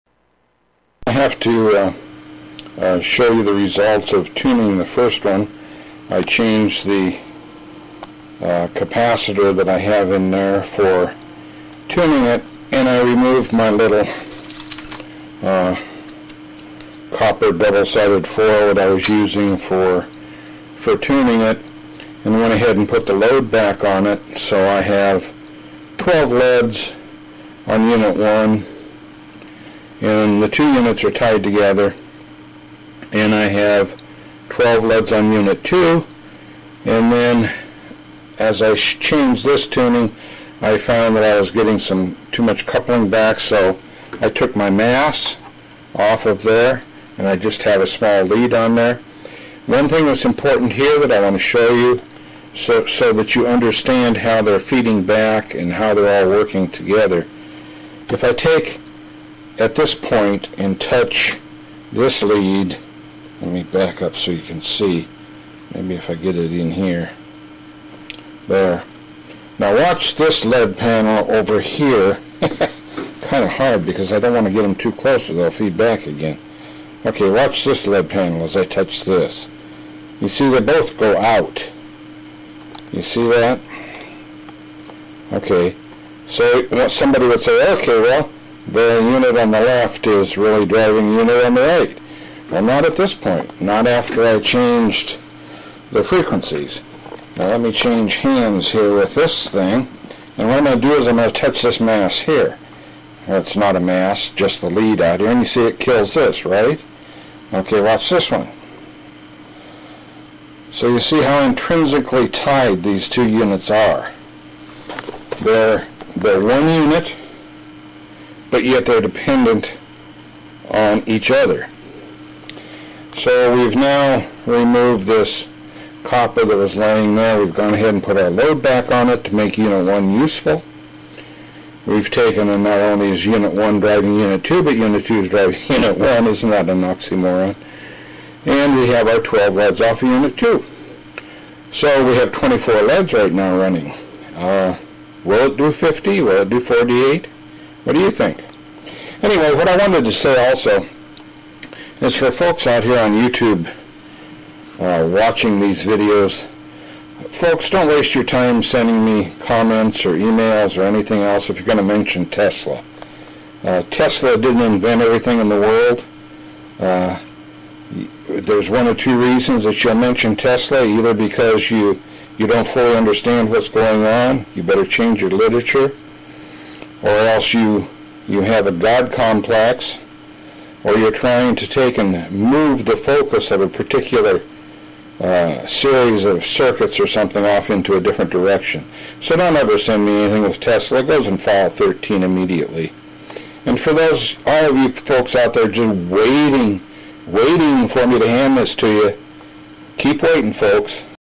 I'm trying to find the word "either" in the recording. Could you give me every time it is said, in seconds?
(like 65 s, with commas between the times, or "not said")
170 s.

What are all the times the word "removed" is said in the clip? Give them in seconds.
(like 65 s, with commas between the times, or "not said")
13 s, 124 s.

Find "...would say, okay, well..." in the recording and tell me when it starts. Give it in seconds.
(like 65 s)
87 s.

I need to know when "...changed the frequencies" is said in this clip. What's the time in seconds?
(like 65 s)
94 s.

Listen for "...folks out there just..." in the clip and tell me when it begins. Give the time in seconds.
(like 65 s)
194 s.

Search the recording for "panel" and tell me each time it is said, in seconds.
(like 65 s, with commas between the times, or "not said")
70 s, 78 s.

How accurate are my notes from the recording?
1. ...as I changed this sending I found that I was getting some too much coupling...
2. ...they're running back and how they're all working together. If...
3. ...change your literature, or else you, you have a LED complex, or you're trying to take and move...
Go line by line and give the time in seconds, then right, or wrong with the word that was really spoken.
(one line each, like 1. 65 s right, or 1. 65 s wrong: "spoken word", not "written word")
1. 38 s wrong: "tuning", not "sending"
2. 54 s wrong: "feeding", not "running"
3. 174 s wrong: "God", not "LED".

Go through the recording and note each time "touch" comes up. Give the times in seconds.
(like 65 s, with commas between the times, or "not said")
60 s, 78 s, 101 s.